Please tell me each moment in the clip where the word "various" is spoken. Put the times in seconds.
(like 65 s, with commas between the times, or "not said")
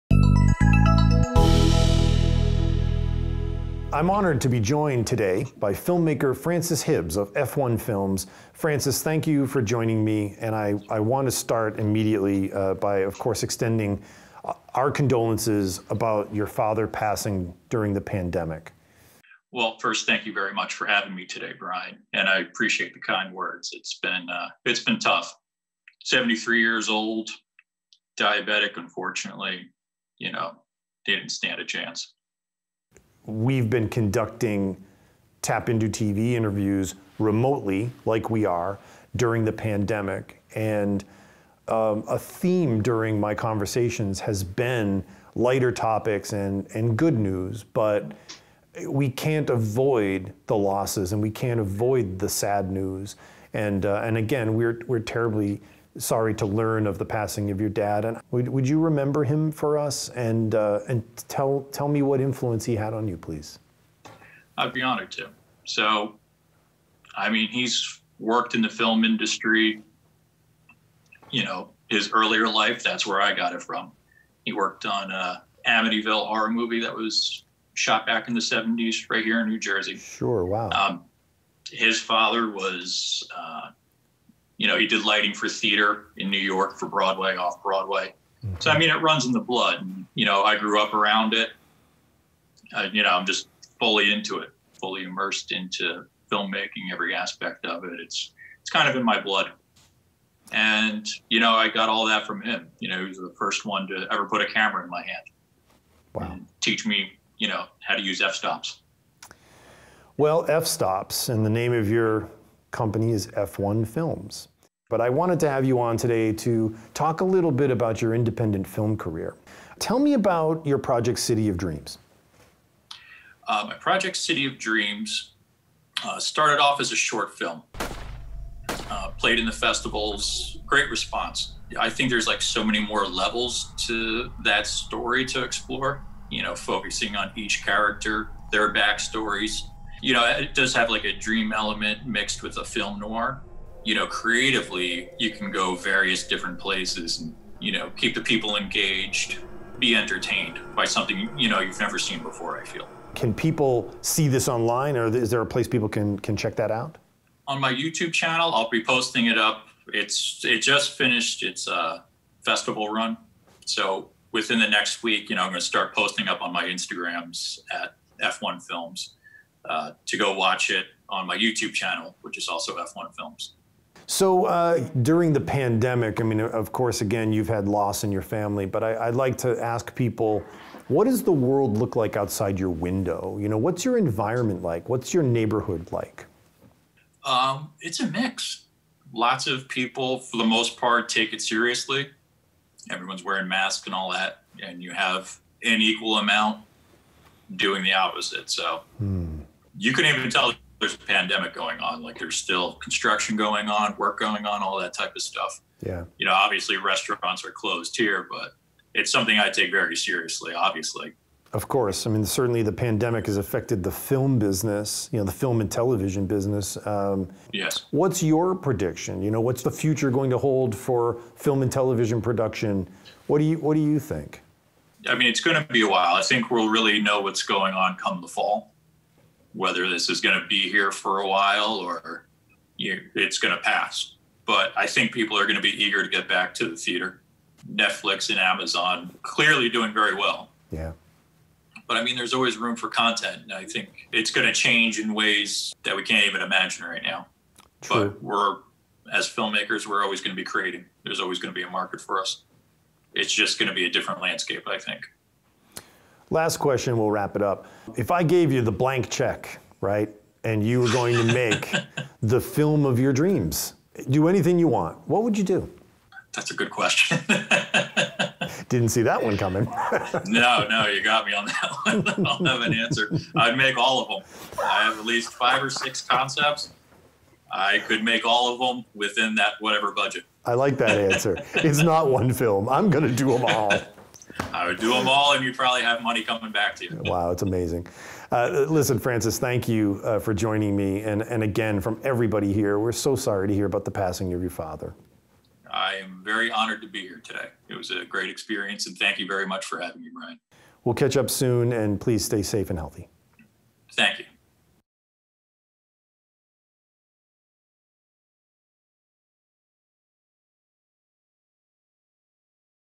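145 s.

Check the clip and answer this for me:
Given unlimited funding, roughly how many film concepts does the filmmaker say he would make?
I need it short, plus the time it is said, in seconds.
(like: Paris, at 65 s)
5 or 6, at 275 s.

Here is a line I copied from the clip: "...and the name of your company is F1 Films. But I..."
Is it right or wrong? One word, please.
right.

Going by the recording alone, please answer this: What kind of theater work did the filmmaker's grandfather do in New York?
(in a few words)
Lighting.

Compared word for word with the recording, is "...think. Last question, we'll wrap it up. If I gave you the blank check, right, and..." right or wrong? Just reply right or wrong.
right.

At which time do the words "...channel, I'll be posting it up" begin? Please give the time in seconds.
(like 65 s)
158 s.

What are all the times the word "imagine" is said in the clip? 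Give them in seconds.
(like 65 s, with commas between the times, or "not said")
246 s.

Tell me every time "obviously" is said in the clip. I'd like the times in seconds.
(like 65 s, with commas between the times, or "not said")
206 s, 210 s.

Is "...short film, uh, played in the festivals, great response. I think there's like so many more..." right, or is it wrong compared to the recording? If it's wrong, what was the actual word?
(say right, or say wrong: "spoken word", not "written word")
right.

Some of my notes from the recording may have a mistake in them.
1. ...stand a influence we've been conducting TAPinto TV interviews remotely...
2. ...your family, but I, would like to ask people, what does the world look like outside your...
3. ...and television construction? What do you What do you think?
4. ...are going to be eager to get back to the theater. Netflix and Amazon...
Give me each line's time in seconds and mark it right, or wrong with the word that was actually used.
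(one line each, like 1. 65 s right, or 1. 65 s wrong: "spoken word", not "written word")
1. 31 s wrong: "chance", not "influence"
2. 178 s right
3. 221 s wrong: "production", not "construction"
4. 235 s right.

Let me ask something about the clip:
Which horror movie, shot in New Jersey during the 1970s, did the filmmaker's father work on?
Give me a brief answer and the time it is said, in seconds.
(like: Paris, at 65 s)
Amityville Horror, at 75 s.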